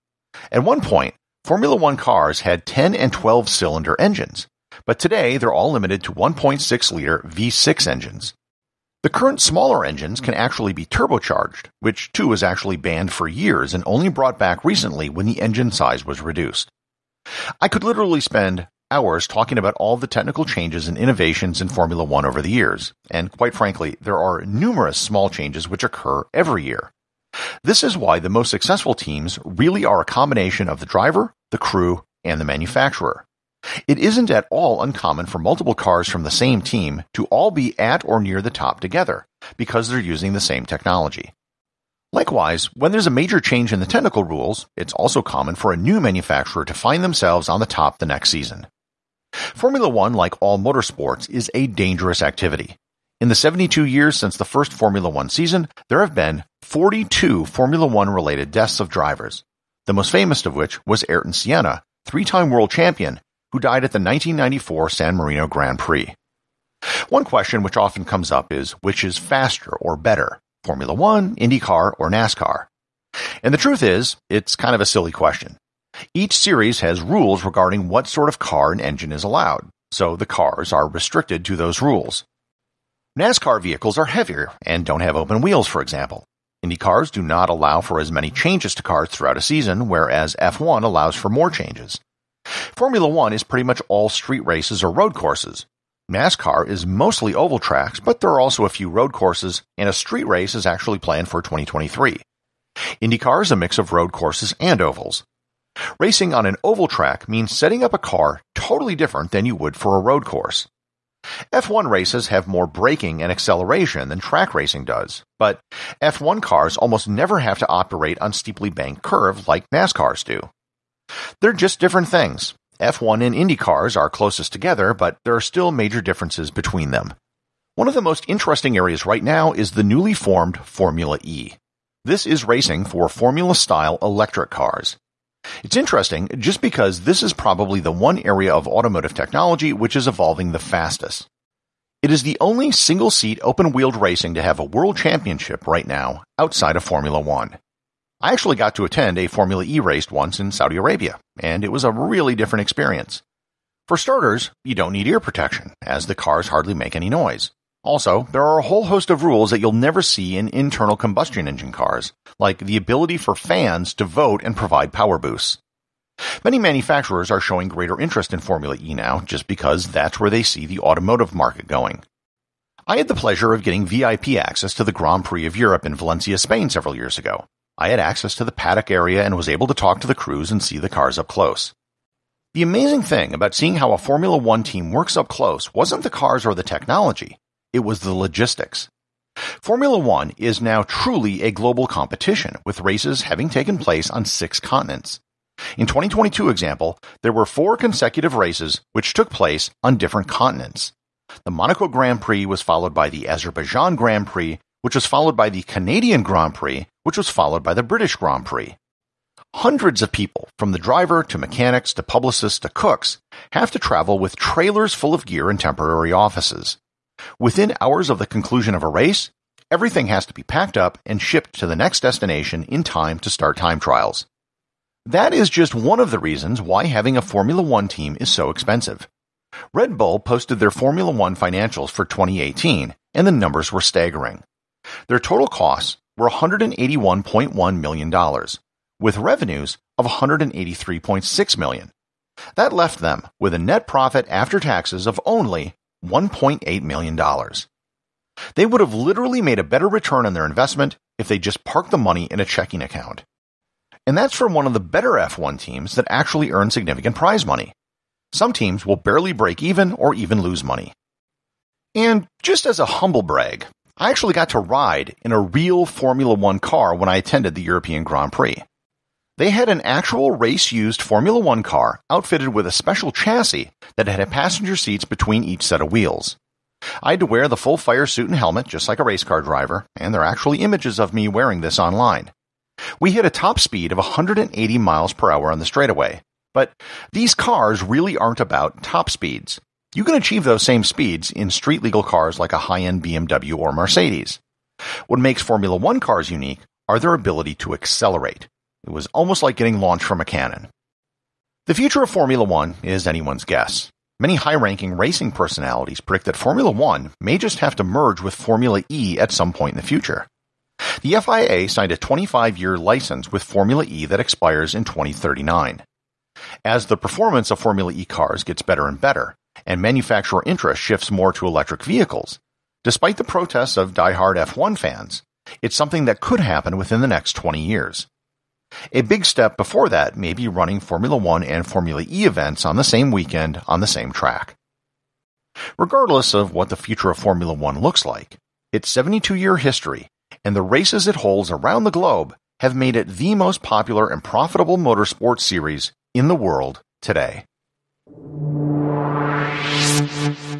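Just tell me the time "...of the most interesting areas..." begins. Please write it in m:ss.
2:07.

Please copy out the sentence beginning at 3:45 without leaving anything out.
That is just one of the reasons why having a Formula One team is so expensive.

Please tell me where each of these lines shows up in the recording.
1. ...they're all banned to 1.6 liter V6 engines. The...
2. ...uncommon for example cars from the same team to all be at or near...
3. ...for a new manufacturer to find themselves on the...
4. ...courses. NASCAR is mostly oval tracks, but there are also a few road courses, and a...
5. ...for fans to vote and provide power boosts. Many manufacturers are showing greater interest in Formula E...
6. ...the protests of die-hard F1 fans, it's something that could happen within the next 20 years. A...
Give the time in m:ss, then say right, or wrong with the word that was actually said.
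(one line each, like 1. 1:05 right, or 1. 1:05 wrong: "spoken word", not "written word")
1. 0:05 wrong: "limited", not "banned"
2. 0:34 wrong: "multiple", not "example"
3. 0:45 right
4. 1:35 right
5. 2:43 right
6. 5:23 right.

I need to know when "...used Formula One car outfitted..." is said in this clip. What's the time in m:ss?
4:30.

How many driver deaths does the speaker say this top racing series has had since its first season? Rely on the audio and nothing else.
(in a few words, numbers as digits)
42.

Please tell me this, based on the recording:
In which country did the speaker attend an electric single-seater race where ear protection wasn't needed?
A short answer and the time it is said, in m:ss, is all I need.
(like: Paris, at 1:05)
Saudi Arabia, at 2:30.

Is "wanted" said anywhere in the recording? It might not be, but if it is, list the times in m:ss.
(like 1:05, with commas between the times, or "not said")
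not said.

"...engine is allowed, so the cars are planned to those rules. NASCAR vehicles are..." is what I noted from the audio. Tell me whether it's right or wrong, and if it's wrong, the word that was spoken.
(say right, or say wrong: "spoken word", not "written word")
wrong: "restricted", not "planned".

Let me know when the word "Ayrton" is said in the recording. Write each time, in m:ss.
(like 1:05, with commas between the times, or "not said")
1:01.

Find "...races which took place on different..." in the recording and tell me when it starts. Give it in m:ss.
3:18.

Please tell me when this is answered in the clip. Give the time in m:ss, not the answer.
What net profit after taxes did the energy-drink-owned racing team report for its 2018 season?
4:06.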